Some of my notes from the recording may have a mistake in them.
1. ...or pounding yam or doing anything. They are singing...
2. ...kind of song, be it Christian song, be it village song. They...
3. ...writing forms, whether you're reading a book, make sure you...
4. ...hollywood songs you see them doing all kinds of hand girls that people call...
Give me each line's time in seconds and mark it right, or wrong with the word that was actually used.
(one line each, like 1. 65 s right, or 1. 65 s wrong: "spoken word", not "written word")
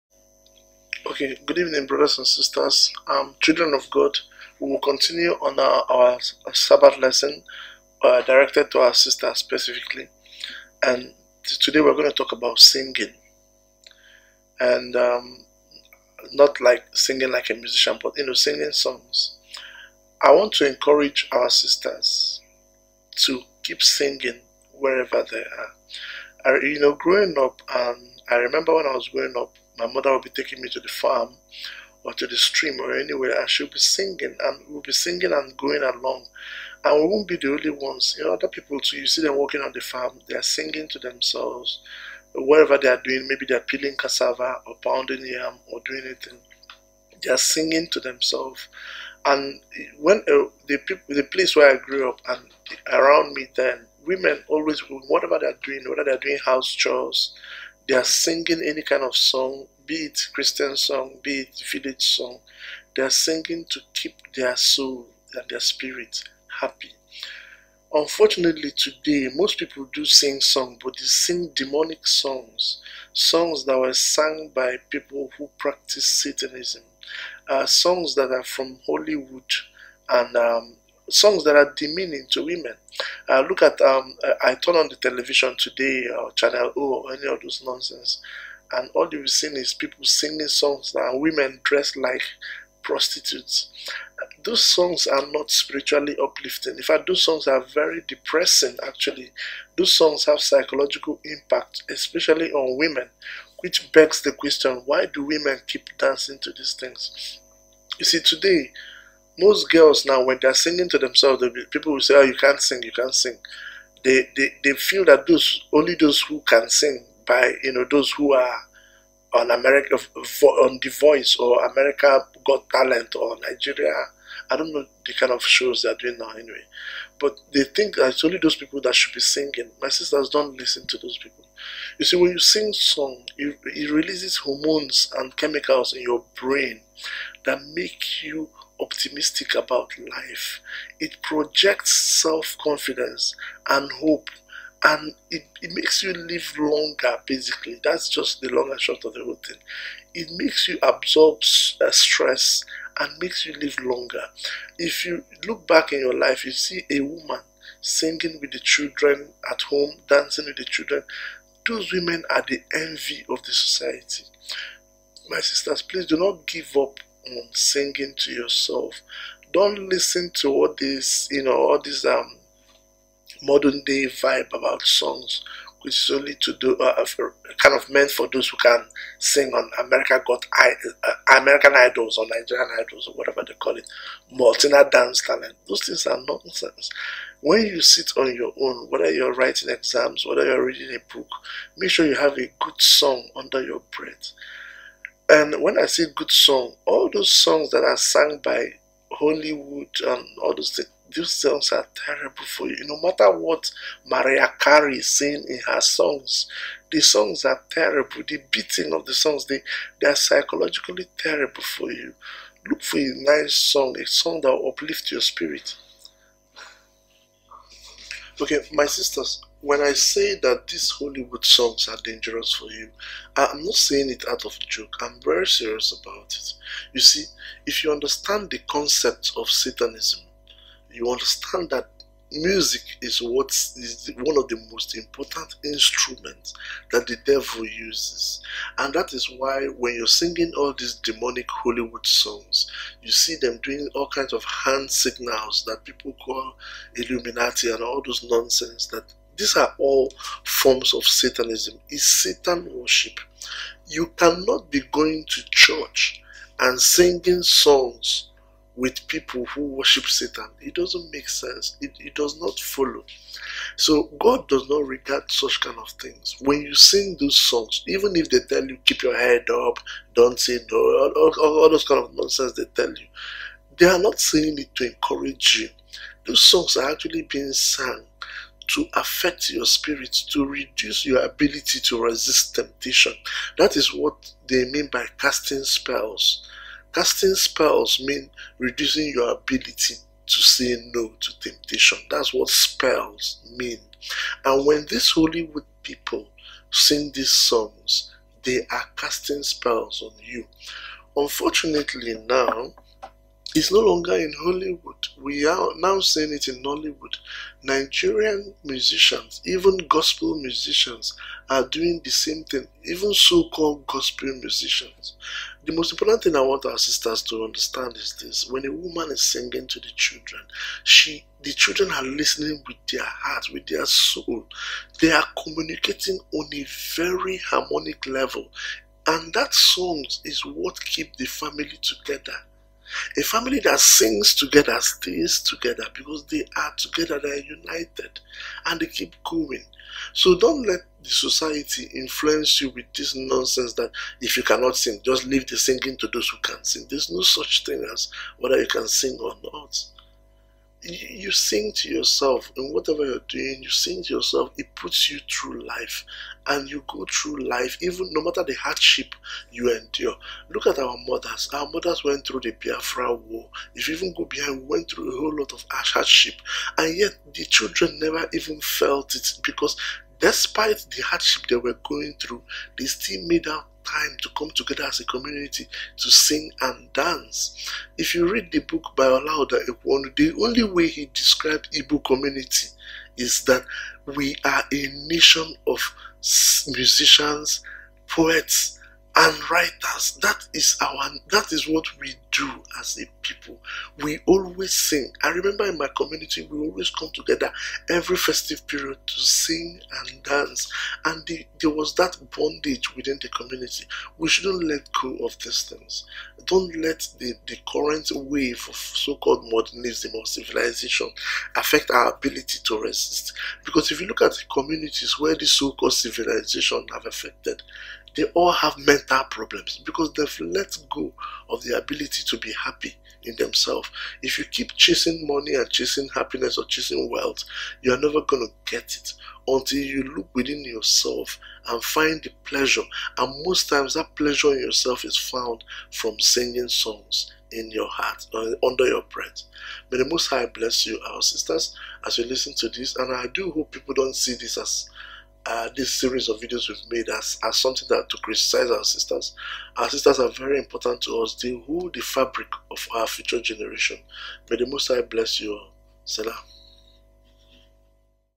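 1. 44 s right
2. 58 s right
3. 189 s wrong: "exams", not "forms"
4. 241 s wrong: "signals", not "girls".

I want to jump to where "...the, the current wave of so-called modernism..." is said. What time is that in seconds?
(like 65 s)
407 s.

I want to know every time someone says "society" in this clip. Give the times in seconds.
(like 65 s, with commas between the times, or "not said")
163 s, 341 s.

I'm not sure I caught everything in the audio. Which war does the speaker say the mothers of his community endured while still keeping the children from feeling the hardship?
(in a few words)
Biafra War.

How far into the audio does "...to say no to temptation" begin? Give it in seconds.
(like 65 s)
290 s.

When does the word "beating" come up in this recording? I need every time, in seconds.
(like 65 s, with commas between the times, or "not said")
208 s.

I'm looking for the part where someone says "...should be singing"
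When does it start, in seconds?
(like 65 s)
128 s.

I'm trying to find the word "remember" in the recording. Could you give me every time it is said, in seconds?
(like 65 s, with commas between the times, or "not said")
28 s, 395 s.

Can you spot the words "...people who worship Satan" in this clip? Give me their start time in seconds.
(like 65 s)
259 s.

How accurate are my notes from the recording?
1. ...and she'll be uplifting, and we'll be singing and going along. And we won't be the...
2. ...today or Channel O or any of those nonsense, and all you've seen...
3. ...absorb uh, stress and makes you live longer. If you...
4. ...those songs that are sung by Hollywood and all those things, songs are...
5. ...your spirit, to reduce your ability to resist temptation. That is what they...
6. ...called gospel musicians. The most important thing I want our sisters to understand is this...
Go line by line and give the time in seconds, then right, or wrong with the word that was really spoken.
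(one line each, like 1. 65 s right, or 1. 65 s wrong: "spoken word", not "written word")
1. 33 s wrong: "singing", not "uplifting"
2. 85 s right
3. 150 s right
4. 197 s right
5. 279 s right
6. 313 s right.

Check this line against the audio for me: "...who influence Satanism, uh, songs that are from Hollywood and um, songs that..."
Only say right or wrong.
wrong.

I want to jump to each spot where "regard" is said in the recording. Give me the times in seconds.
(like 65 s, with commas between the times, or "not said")
264 s.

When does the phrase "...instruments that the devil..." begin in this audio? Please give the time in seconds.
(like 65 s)
235 s.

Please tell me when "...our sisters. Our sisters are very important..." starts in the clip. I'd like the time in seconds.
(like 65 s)
448 s.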